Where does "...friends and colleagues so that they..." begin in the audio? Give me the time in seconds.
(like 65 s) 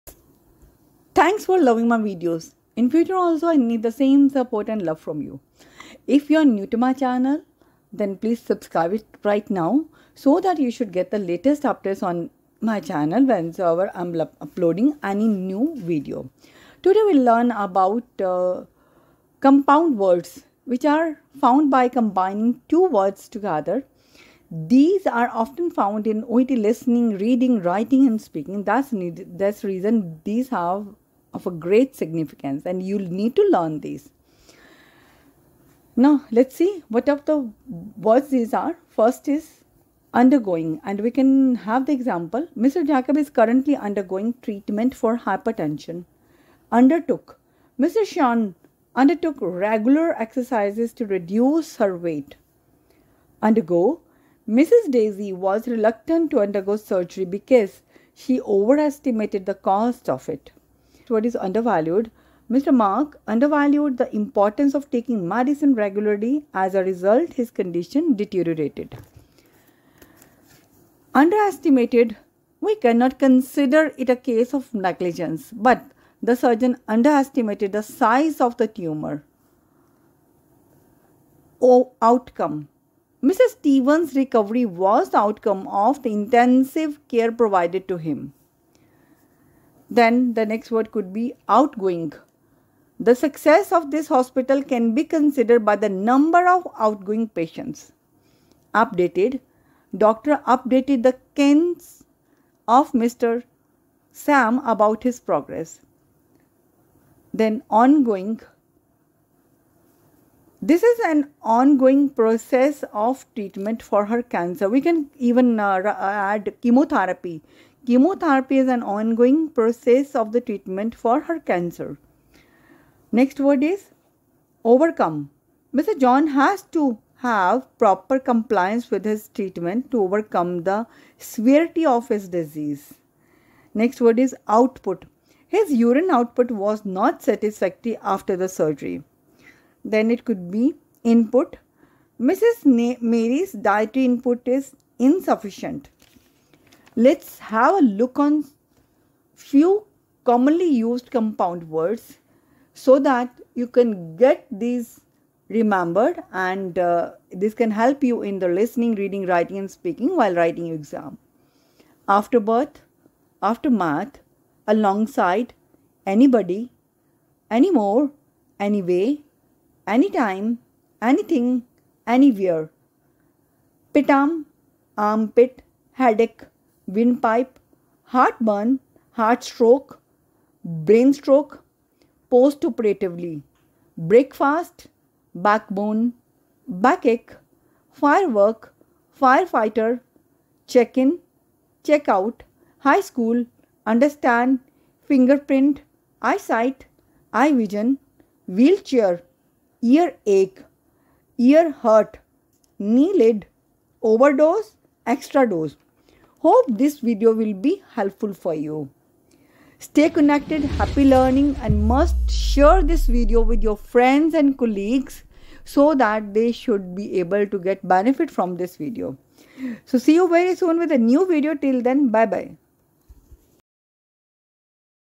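213 s.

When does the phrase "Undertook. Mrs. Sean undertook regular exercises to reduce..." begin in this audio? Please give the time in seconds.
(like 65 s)
46 s.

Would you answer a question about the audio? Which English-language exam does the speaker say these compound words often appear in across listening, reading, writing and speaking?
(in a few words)
OET.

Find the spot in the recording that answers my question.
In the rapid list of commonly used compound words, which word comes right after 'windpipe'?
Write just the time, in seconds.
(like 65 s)
178 s.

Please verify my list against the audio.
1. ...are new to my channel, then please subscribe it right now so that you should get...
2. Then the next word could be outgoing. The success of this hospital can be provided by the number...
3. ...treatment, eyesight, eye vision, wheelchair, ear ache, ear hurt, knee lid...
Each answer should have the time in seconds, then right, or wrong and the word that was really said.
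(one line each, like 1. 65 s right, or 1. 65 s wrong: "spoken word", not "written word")
1. 6 s right
2. 89 s wrong: "considered", not "provided"
3. 195 s wrong: "fingerprint", not "treatment".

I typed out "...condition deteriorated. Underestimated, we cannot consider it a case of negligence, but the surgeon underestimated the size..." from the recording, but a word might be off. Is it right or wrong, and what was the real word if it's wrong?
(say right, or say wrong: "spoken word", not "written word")
right.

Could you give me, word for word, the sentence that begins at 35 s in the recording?
Now, let's see what of the words these are.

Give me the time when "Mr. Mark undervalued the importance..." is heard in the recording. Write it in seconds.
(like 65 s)
62 s.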